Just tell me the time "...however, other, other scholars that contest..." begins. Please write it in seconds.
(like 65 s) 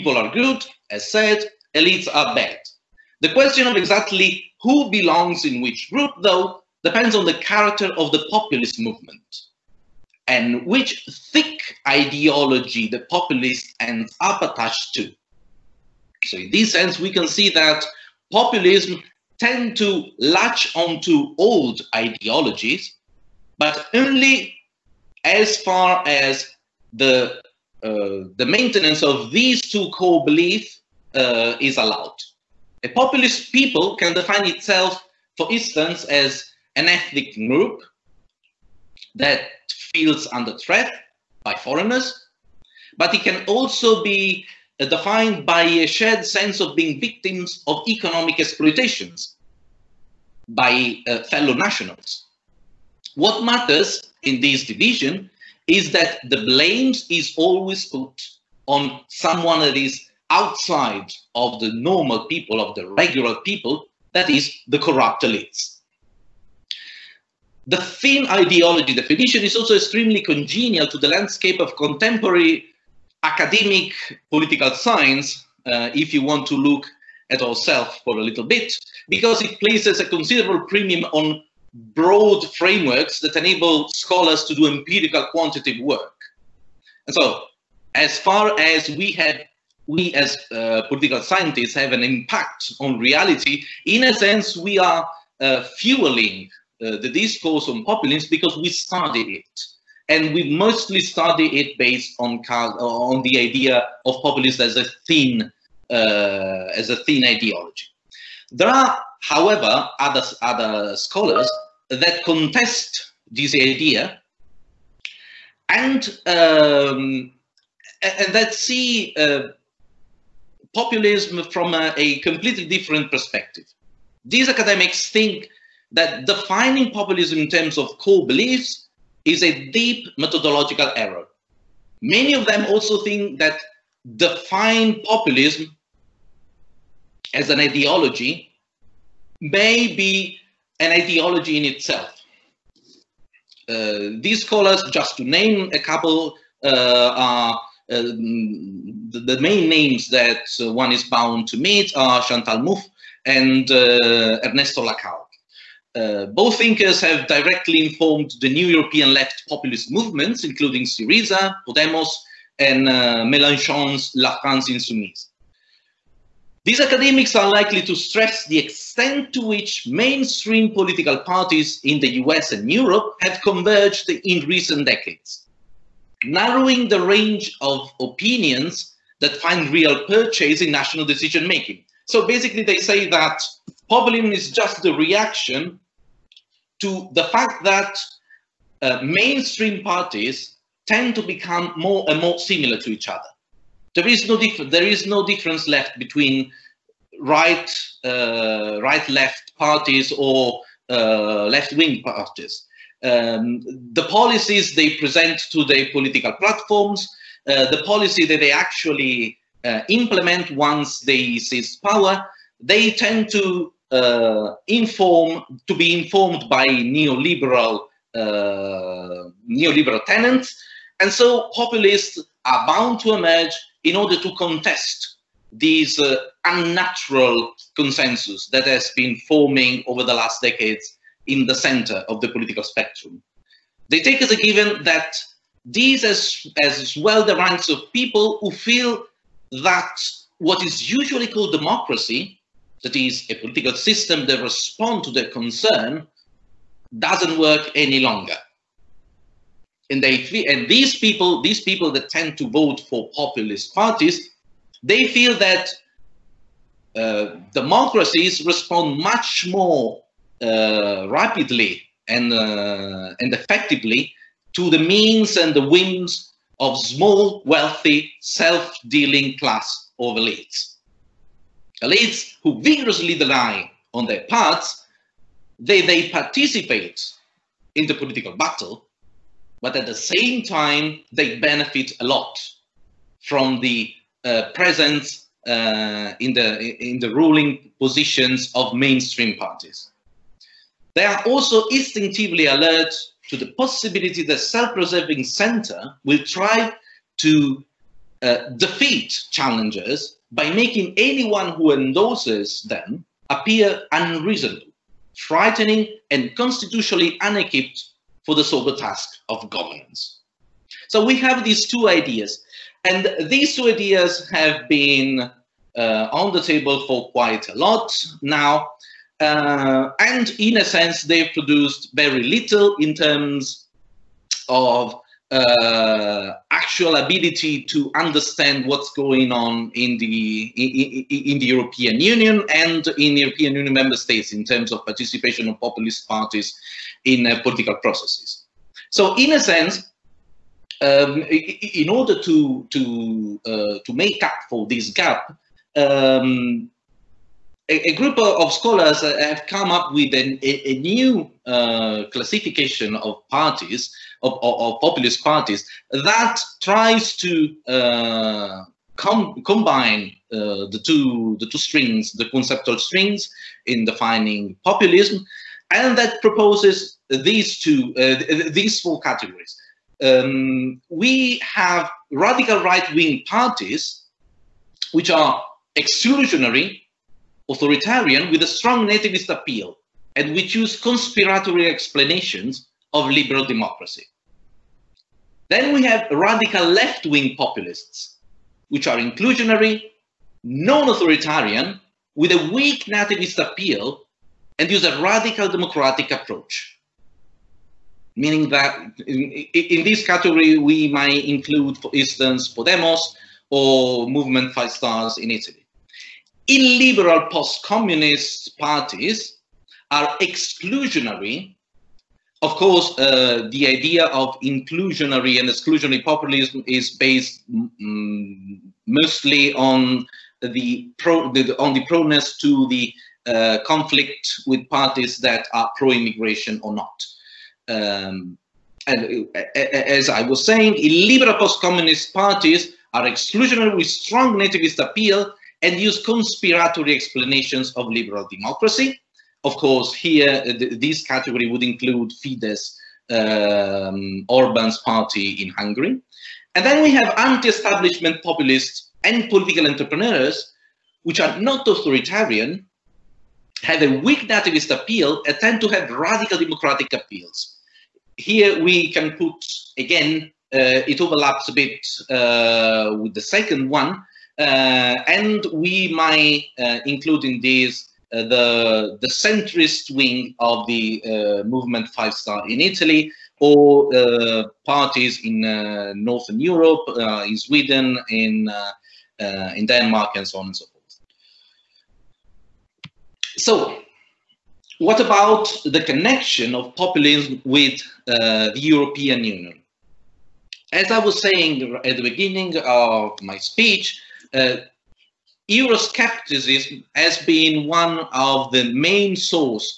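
109 s.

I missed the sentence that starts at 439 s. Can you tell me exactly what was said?
Of course, here, uh, th this category would include Fidesz, um, Orban's party in Hungary.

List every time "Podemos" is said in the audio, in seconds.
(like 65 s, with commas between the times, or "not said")
161 s, 402 s.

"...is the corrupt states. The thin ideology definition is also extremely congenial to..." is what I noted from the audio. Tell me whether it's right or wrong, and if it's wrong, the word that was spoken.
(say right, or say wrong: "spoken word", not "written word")
wrong: "elites", not "states".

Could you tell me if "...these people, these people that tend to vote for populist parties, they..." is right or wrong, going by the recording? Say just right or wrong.
right.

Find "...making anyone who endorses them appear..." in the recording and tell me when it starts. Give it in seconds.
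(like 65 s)
300 s.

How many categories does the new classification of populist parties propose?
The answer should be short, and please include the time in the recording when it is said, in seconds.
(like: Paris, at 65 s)
4, at 368 s.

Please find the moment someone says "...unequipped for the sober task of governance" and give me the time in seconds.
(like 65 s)
307 s.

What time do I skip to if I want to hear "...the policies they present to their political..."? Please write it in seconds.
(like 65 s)
203 s.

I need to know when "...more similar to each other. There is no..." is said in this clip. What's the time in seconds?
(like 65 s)
192 s.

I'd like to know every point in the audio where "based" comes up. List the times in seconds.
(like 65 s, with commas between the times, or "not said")
101 s, 416 s.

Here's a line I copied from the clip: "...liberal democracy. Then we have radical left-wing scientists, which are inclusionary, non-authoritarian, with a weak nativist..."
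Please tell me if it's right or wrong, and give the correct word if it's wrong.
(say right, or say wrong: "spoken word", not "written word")
wrong: "populists", not "scientists".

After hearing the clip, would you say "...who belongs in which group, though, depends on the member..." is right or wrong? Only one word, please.
wrong.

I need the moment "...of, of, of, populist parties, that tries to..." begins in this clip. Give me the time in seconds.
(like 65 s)
354 s.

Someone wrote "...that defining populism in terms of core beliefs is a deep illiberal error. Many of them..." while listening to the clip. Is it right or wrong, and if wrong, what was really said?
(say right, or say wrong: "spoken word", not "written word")
wrong: "methodological", not "illiberal".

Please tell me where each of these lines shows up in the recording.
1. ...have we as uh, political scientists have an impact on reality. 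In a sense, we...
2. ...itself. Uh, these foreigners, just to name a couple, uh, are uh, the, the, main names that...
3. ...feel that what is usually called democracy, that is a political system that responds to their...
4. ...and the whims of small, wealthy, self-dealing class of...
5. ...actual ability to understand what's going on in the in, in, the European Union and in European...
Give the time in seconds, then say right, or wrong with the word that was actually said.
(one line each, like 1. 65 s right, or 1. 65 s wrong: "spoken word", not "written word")
1. 89 s right
2. 141 s wrong: "scholars", not "foreigners"
3. 238 s right
4. 265 s right
5. 326 s right.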